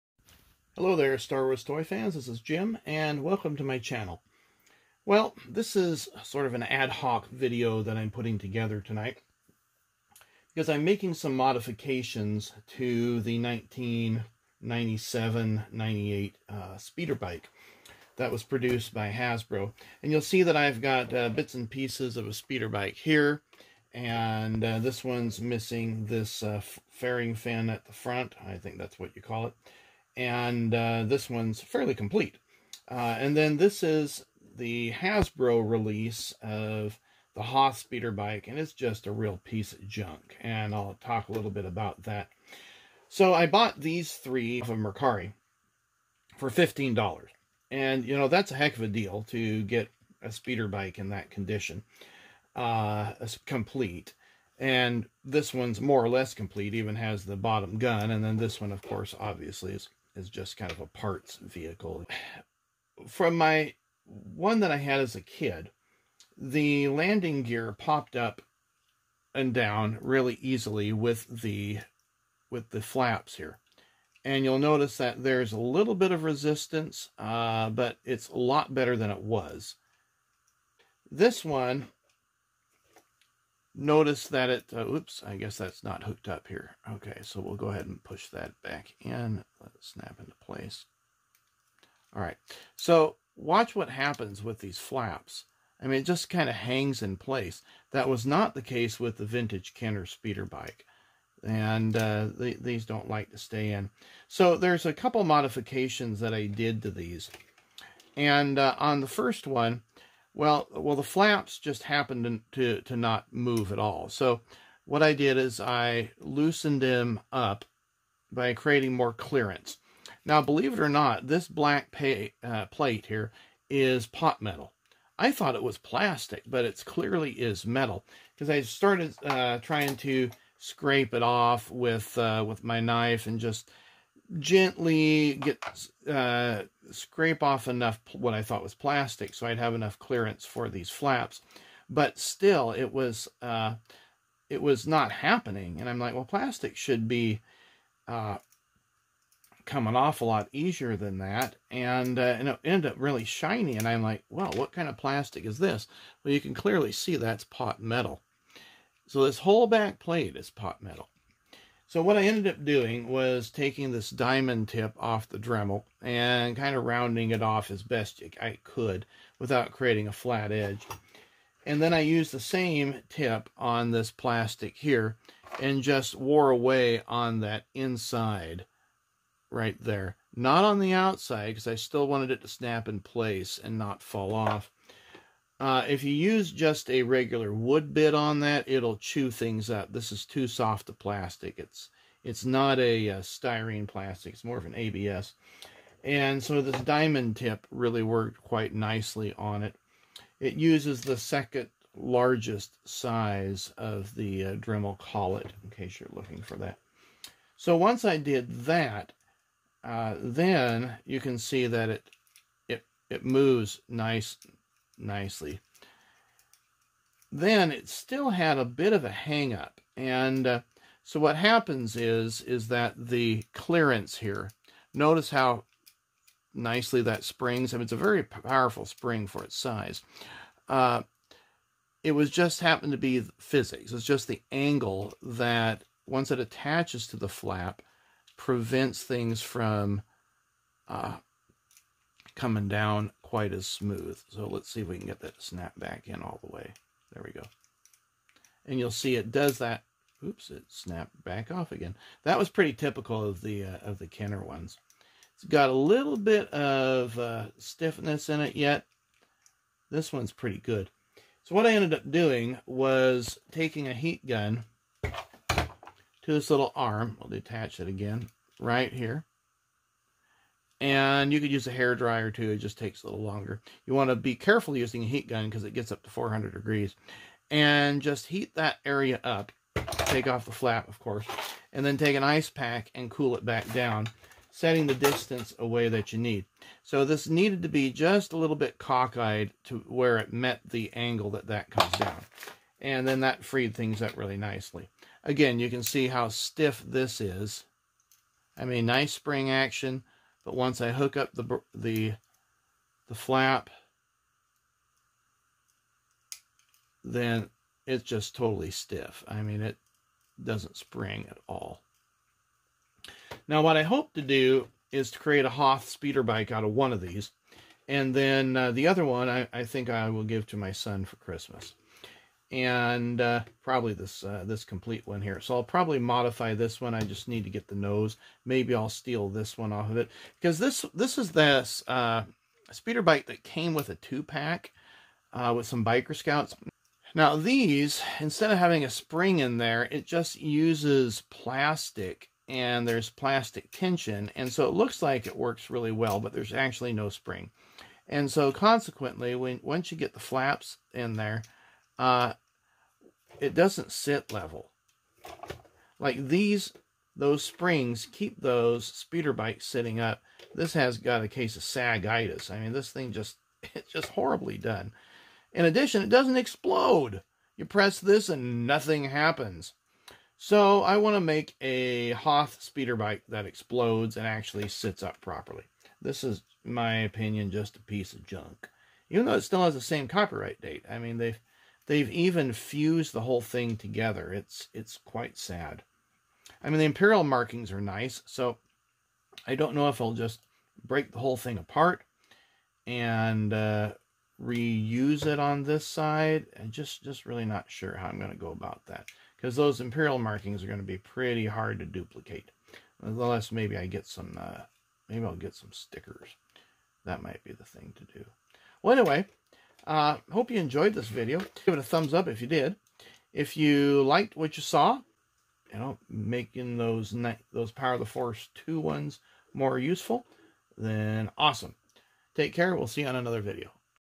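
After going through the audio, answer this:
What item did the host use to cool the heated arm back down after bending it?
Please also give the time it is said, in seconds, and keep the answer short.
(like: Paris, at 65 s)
ice pack, at 282 s.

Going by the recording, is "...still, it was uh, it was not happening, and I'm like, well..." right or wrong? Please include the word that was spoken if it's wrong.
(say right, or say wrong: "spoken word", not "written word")
right.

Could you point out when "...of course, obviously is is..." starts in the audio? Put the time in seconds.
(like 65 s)
58 s.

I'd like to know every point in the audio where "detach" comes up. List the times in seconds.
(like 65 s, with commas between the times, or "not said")
267 s.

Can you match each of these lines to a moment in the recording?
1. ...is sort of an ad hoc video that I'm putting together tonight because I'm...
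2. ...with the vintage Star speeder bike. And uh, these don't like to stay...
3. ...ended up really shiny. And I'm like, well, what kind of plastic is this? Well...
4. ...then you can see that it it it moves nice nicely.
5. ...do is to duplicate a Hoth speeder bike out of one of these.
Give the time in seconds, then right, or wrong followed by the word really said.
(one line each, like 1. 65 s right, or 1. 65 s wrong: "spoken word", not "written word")
1. 5 s right
2. 98 s wrong: "Kenner", not "Star"
3. 152 s right
4. 210 s right
5. 314 s wrong: "create", not "duplicate".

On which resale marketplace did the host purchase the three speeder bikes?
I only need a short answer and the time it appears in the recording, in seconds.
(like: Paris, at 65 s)
Mercari, at 44 s.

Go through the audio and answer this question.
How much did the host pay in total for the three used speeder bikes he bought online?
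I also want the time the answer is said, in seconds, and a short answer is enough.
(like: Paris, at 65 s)
$15, at 46 s.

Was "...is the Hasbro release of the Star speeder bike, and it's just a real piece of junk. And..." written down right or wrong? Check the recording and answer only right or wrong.
wrong.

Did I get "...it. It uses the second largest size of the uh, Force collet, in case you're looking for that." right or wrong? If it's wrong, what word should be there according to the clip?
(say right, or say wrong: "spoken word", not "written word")
wrong: "Dremel", not "Force".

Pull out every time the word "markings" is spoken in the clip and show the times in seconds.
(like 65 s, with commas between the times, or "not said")
387 s, 400 s.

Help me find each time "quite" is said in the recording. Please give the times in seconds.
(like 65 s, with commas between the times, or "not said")
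198 s, 243 s, 385 s.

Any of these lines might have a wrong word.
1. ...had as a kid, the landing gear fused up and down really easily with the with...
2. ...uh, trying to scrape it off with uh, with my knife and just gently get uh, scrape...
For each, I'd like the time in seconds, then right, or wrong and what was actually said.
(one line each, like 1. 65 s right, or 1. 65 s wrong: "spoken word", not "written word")
1. 64 s wrong: "popped", not "fused"
2. 129 s right.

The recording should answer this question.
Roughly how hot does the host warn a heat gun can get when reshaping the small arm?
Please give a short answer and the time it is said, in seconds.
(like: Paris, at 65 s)
400 degrees, at 276 s.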